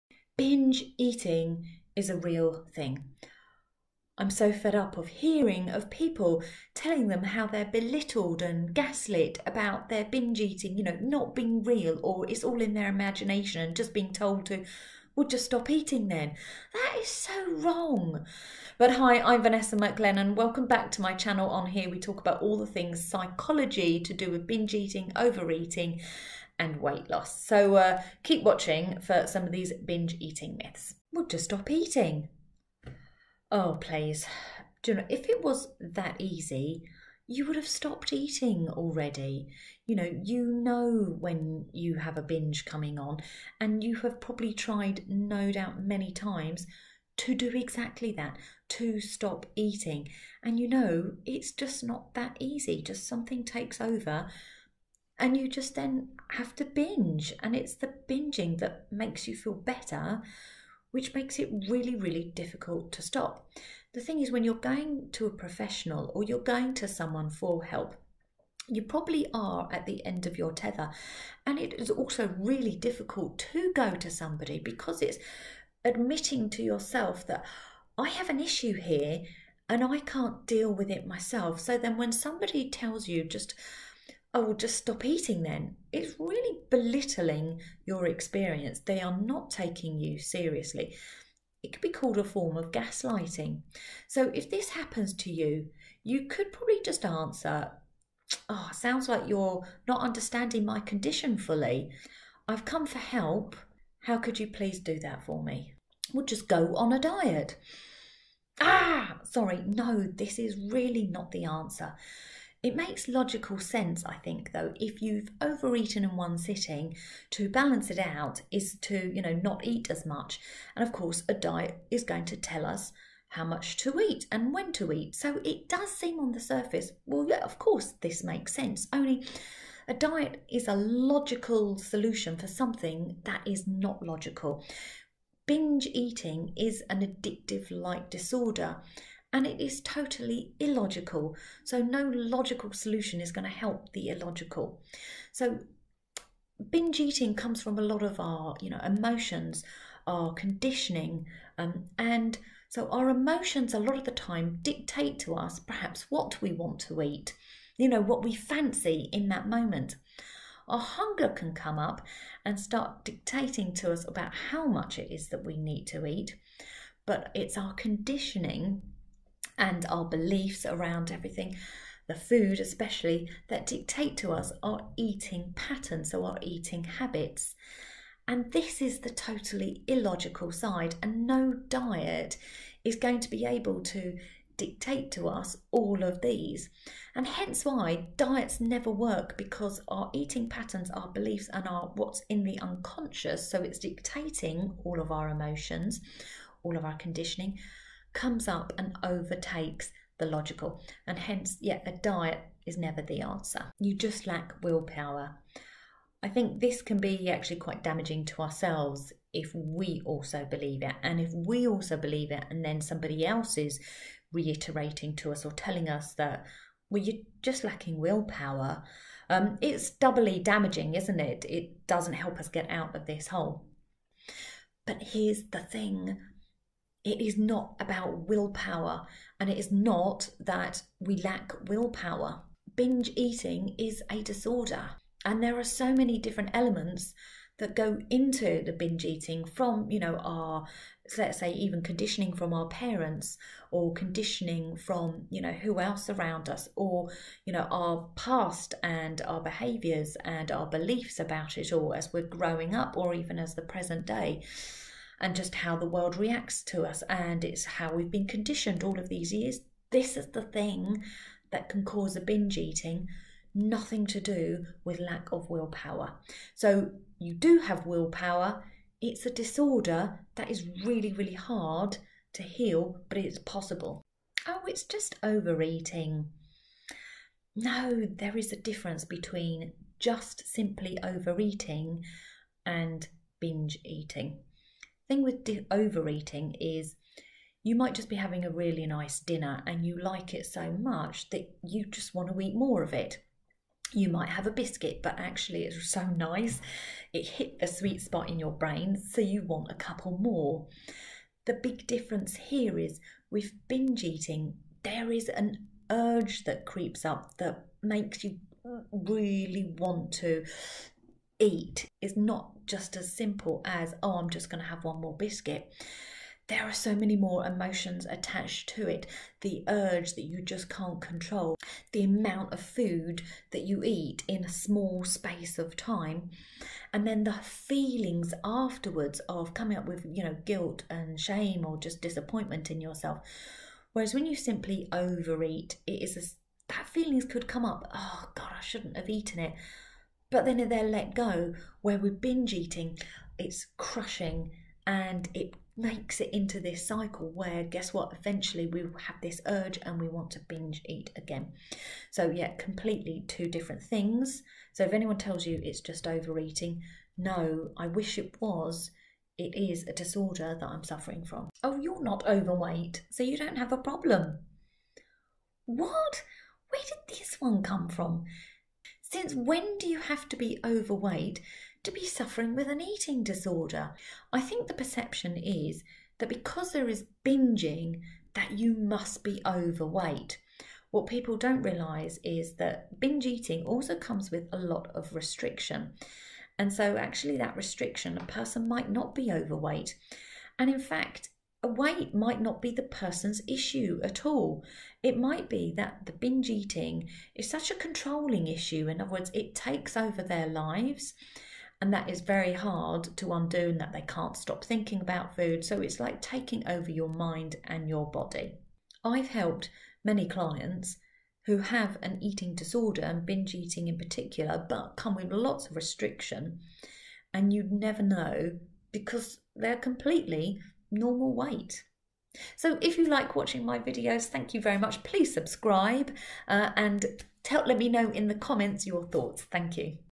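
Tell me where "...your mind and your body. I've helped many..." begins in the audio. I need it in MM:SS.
06:46.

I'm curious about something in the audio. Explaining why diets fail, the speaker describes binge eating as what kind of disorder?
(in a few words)
addictive like disorder.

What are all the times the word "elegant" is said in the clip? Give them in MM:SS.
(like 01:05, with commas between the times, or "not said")
not said.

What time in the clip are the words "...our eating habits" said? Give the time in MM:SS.
02:56.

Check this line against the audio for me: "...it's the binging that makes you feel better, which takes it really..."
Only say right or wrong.
wrong.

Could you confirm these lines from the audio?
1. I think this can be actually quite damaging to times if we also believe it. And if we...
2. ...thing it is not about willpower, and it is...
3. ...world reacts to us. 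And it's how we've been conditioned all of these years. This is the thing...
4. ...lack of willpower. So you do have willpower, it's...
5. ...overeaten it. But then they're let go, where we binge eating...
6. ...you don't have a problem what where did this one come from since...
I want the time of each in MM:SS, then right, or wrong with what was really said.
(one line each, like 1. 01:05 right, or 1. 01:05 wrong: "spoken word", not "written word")
1. 03:26 wrong: "ourselves", not "times"
2. 03:45 right
3. 04:15 right
4. 04:24 right
5. 05:39 wrong: "eaten", not "overeaten"
6. 06:03 right.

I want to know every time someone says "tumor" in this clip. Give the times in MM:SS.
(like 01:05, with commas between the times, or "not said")
not said.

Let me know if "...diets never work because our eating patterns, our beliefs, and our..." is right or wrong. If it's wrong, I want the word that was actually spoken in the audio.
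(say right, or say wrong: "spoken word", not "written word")
right.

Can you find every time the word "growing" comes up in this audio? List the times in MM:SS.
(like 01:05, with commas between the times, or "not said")
04:12.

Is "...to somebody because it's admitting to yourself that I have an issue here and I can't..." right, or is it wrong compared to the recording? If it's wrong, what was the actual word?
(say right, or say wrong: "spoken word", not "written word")
right.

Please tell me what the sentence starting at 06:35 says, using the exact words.
It might be that the binge eating is such a controlling issue.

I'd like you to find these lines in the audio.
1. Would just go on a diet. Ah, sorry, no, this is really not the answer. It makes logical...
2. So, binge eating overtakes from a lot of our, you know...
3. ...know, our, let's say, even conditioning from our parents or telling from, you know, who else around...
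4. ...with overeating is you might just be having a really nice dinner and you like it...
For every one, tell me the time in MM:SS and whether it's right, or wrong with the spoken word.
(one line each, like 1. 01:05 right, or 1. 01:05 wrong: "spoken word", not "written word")
1. 01:46 right
2. 02:25 wrong: "comes", not "overtakes"
3. 03:59 wrong: "conditioning", not "telling"
4. 04:45 right.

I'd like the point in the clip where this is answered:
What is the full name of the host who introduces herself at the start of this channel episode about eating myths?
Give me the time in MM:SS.
00:19.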